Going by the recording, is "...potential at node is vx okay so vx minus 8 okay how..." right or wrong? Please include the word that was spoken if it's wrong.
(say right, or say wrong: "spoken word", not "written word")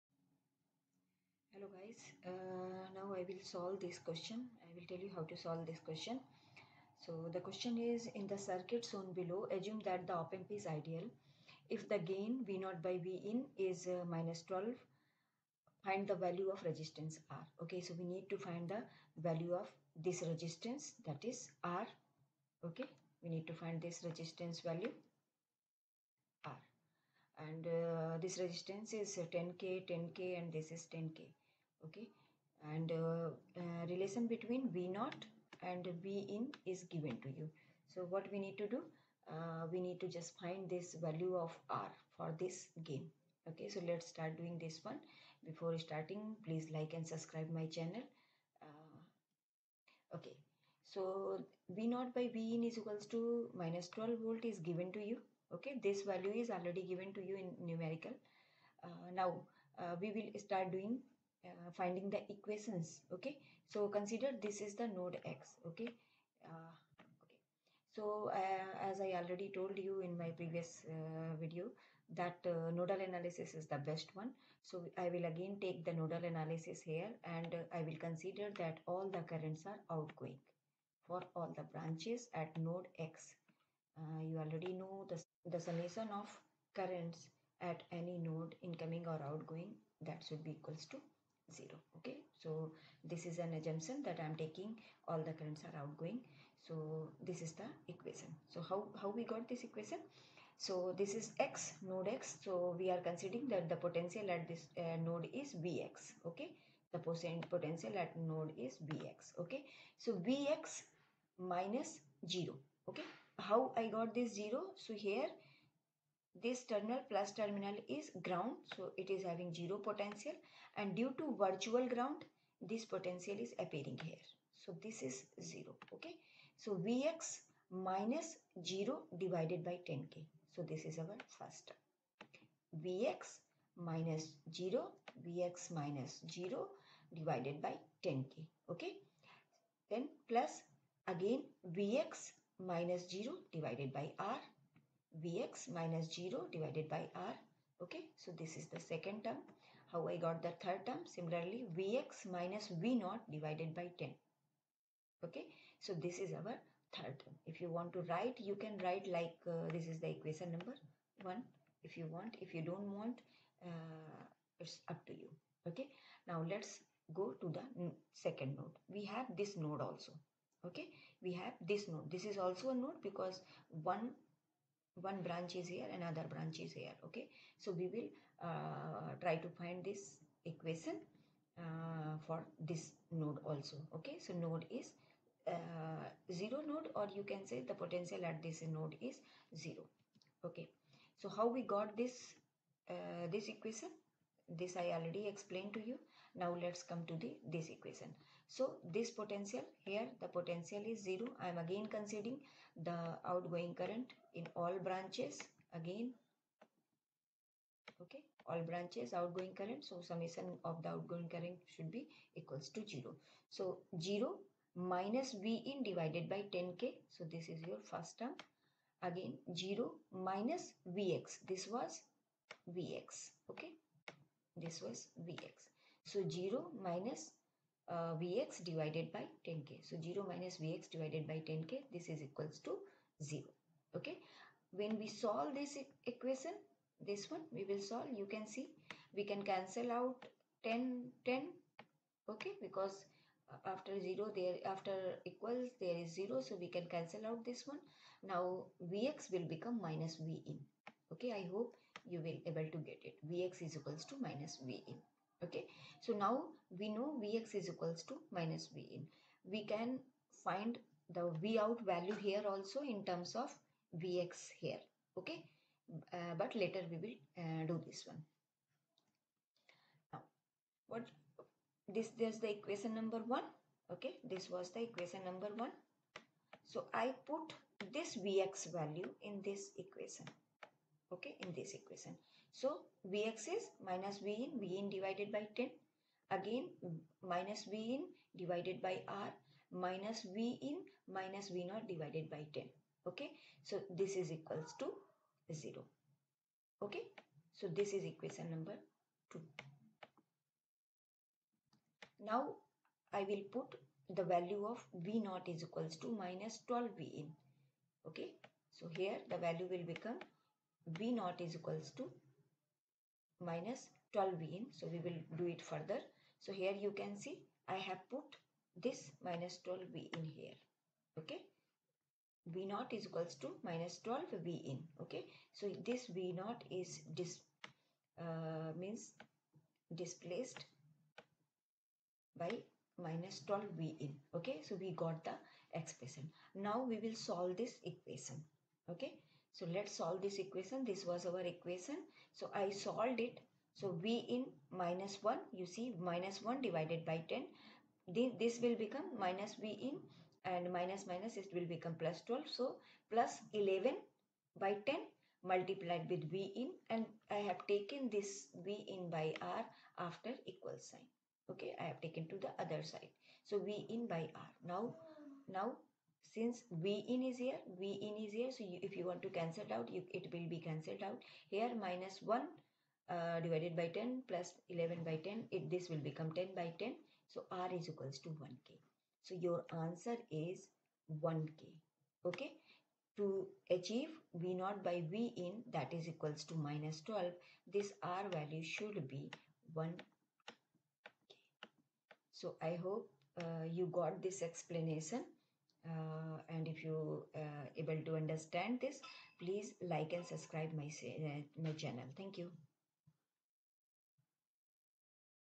wrong: "0", not "8".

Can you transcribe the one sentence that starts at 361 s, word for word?
Okay, I have taken to the other side.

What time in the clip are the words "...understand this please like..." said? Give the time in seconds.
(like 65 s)
398 s.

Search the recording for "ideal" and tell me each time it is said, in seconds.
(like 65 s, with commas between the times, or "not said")
10 s.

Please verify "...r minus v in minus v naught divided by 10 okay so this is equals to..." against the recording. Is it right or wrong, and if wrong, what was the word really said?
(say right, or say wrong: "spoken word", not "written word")
right.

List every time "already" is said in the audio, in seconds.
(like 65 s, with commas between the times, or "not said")
56 s, 69 s, 84 s, 194 s.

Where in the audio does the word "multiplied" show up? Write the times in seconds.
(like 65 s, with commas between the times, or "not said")
355 s.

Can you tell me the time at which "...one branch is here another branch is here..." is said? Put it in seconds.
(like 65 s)
174 s.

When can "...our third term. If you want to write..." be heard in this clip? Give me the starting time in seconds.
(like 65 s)
156 s.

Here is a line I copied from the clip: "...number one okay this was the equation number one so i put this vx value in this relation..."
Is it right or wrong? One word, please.
wrong.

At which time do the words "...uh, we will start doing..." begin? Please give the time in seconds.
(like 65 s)
59 s.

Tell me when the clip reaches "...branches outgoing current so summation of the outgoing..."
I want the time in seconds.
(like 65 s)
208 s.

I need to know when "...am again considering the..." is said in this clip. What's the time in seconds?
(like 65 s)
201 s.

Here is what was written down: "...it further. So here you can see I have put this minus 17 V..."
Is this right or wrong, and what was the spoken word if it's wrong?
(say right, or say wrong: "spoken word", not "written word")
wrong: "12", not "17".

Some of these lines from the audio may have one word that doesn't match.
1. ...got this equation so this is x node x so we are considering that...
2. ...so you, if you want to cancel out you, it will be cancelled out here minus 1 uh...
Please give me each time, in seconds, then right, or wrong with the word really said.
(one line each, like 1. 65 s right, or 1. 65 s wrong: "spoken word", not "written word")
1. 99 s right
2. 368 s right.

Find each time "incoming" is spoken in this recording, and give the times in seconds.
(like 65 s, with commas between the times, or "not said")
88 s.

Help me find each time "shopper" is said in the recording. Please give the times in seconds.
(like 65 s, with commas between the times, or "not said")
not said.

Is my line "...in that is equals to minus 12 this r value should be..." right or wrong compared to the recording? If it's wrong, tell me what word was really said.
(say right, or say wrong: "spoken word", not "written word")
right.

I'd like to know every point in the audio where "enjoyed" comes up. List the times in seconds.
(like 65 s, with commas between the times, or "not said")
not said.